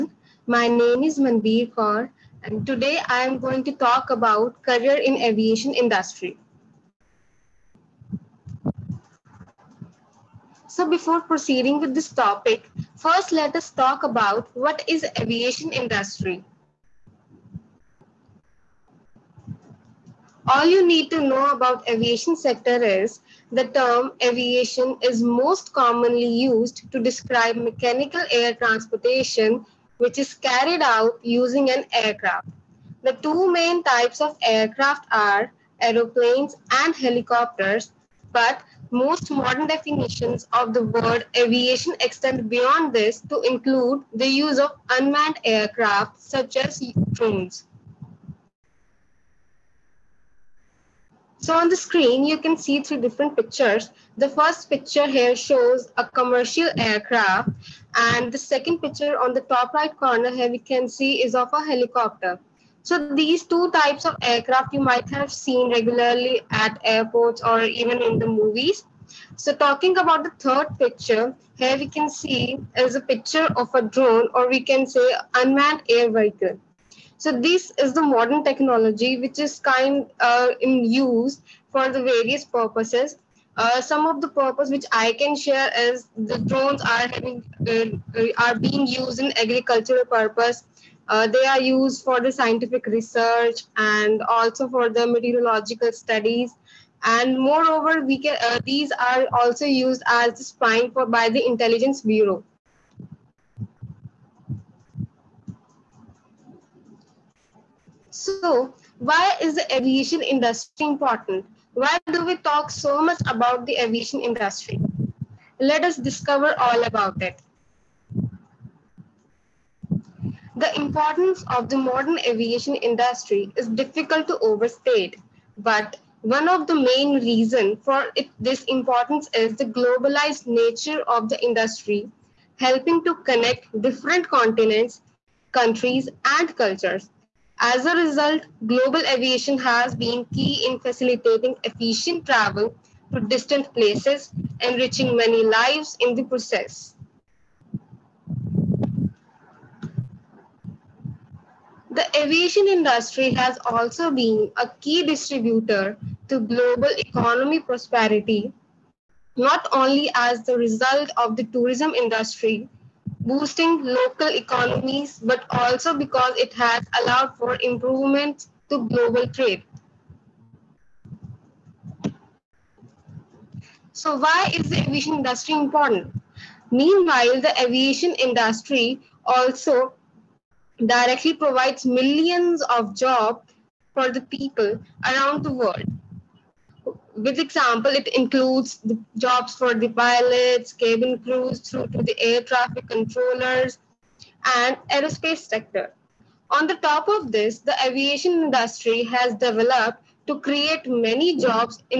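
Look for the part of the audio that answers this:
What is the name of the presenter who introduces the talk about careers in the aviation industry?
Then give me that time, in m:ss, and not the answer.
0:01.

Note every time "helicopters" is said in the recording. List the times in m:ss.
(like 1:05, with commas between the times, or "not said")
0:36, 1:01.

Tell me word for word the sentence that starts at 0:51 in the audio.
So on the screen, you can see three different pictures.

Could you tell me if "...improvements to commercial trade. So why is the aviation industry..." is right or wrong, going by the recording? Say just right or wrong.
wrong.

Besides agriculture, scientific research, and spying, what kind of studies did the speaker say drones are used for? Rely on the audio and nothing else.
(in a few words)
Meteorological studies.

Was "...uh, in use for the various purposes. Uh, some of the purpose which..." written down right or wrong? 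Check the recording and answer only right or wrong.
right.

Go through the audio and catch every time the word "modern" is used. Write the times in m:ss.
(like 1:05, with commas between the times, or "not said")
0:39, 1:18, 2:01.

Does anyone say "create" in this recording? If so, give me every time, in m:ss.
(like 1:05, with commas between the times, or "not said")
3:20.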